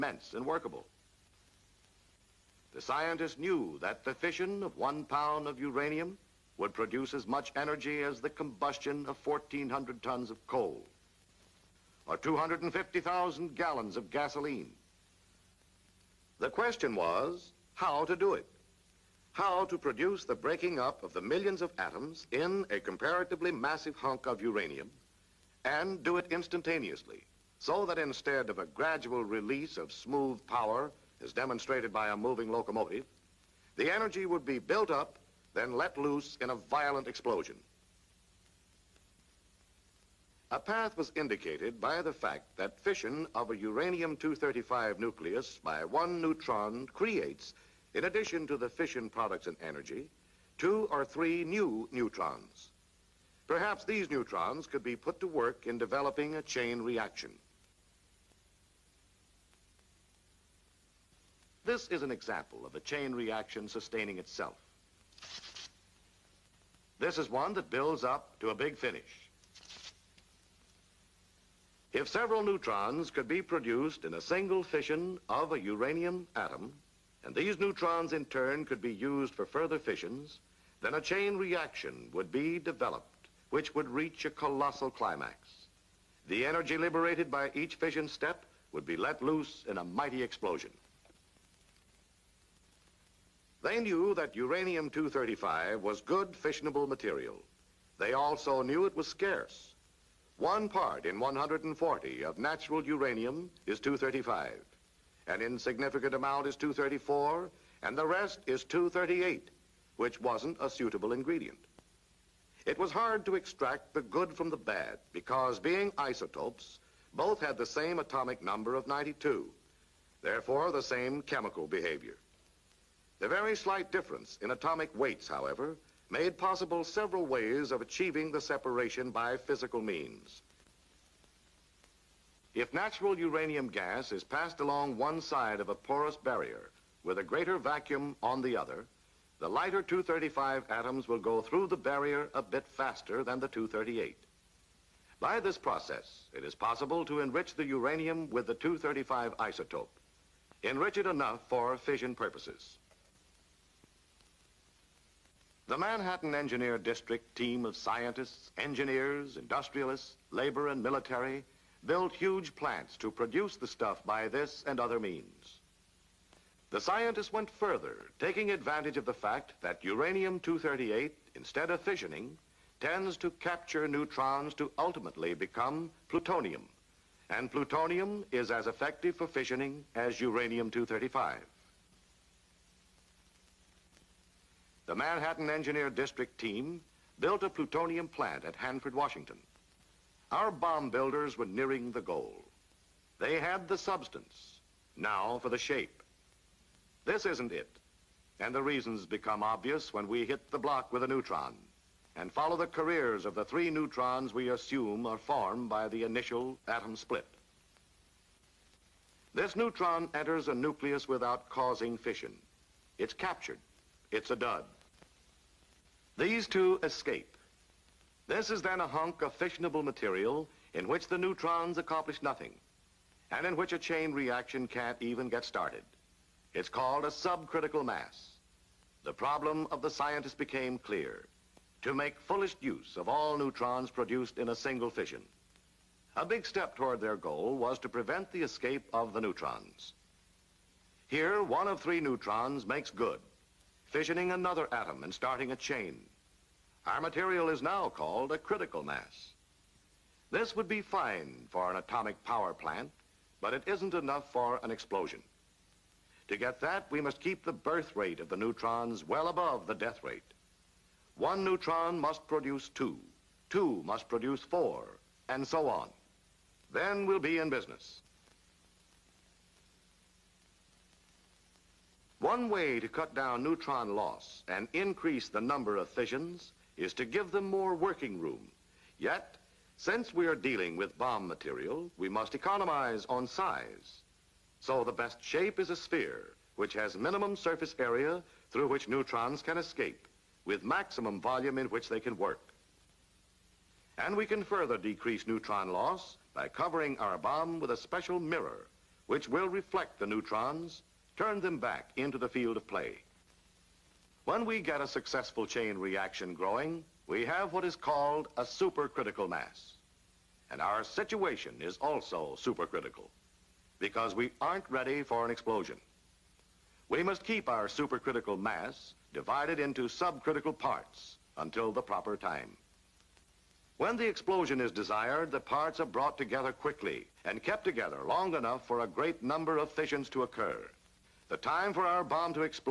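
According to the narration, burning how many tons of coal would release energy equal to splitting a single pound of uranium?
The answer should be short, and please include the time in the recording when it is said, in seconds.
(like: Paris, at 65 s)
1,400 tons, at 9 s.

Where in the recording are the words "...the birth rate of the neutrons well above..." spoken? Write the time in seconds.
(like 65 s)
257 s.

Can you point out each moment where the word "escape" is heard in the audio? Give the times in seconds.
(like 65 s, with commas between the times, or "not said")
216 s, 238 s, 289 s.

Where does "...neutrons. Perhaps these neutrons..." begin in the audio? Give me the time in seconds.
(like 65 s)
51 s.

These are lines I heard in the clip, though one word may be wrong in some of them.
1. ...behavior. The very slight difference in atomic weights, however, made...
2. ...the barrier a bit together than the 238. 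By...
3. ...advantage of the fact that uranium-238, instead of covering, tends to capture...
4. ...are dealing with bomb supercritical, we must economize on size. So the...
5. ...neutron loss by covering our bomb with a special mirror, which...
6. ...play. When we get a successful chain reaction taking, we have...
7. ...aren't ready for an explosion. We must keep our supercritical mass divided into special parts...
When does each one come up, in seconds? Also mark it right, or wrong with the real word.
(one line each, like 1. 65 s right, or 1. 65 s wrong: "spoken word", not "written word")
1. 121 s right
2. 141 s wrong: "faster", not "together"
3. 168 s wrong: "fissioning", not "covering"
4. 280 s wrong: "material", not "supercritical"
5. 295 s right
6. 302 s wrong: "growing", not "taking"
7. 314 s wrong: "subcritical", not "special".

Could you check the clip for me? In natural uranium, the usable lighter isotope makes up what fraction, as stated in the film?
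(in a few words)
1 part in 140.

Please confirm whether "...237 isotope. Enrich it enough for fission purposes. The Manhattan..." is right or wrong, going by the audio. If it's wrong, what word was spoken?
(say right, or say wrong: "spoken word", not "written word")
wrong: "235", not "237".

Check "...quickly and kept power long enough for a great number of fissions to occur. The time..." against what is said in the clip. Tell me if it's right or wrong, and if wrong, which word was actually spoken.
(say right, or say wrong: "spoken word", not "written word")
wrong: "together", not "power".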